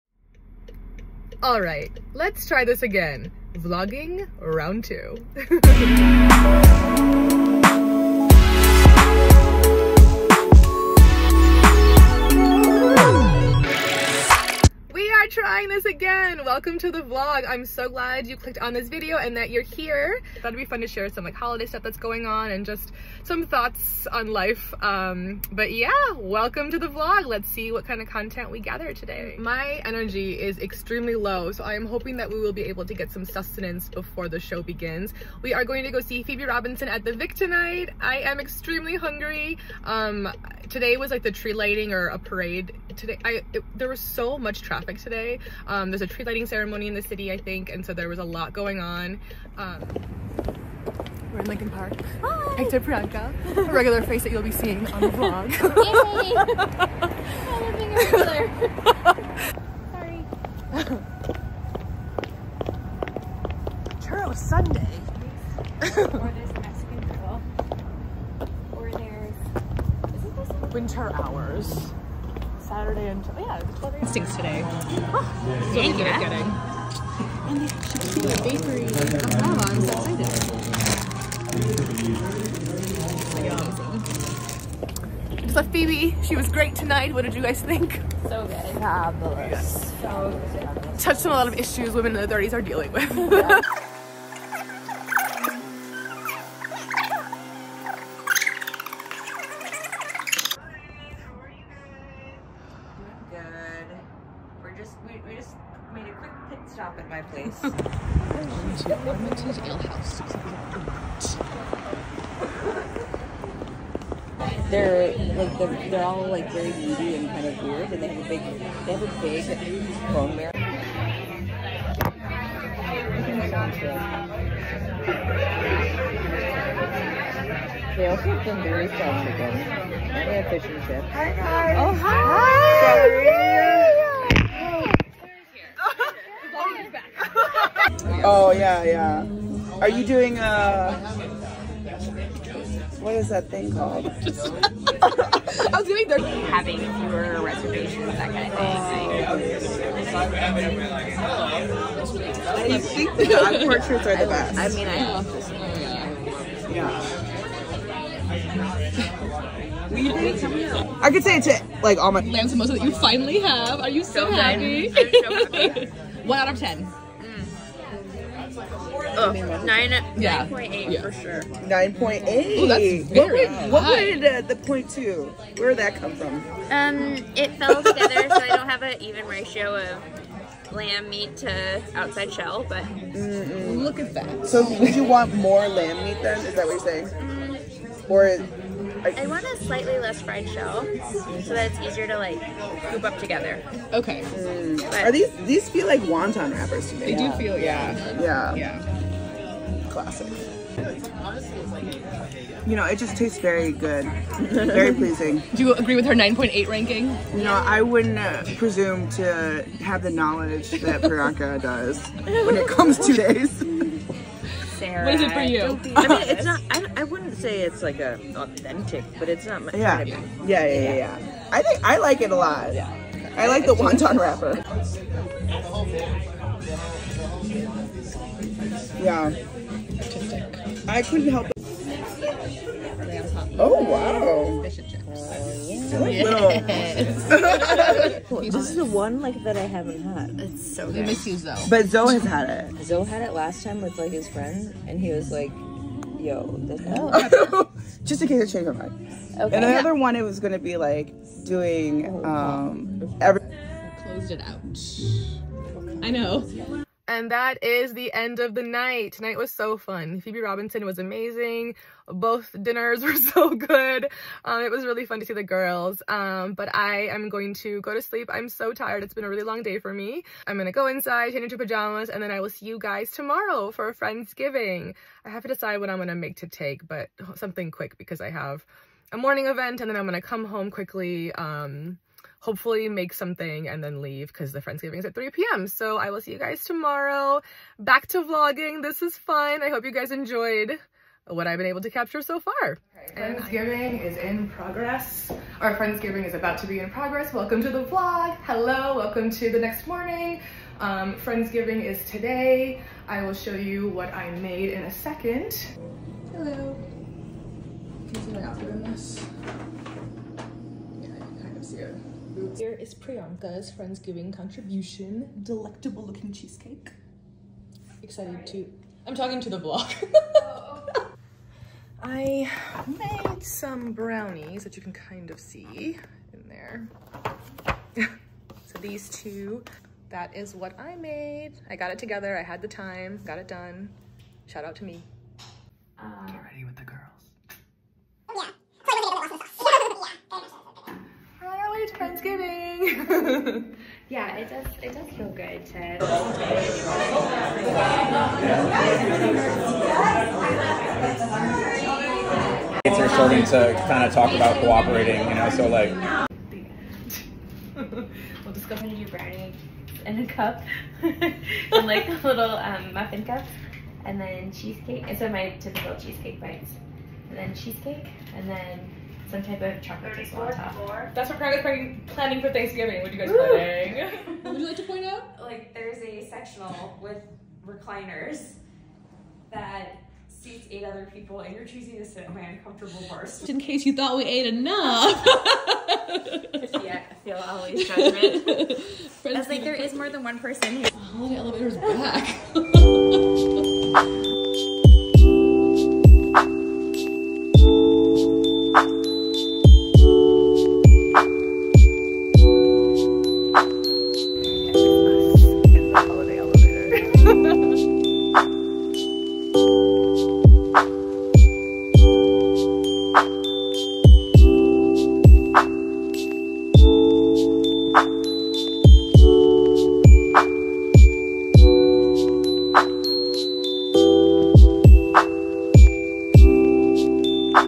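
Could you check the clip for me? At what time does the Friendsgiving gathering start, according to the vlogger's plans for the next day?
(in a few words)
3 p.m.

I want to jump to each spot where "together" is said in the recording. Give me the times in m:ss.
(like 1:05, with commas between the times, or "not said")
2:57, 3:13, 5:31.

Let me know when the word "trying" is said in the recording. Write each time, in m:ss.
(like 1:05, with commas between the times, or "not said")
0:15.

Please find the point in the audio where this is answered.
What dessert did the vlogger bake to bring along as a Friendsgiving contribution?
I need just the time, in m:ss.
5:23.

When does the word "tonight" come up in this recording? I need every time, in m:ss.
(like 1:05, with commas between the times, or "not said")
0:37, 1:26, 4:19.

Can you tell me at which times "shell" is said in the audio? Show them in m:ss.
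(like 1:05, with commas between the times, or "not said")
3:02, 3:10.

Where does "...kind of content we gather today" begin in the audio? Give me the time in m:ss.
0:27.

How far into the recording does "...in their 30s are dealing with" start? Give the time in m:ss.
1:32.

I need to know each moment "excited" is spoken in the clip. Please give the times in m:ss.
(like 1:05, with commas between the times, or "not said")
1:23, 5:18.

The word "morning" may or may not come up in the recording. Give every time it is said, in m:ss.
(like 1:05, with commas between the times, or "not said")
4:39, 4:59.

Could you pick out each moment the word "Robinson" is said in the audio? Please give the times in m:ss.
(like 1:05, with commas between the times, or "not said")
0:36, 4:20.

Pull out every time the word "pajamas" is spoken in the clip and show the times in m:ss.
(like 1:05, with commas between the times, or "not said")
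4:31.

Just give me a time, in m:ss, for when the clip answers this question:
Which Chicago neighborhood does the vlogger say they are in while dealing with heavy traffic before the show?
0:51.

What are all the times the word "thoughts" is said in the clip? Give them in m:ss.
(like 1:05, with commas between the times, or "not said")
0:23, 6:23.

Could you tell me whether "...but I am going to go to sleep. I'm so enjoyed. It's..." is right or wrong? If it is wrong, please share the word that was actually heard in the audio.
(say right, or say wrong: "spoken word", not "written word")
wrong: "tired", not "enjoyed".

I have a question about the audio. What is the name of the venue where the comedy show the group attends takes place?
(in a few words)
the Vic.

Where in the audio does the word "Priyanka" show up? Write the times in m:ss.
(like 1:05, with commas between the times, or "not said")
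0:52, 3:31, 5:12.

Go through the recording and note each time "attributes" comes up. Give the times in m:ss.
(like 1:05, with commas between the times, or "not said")
not said.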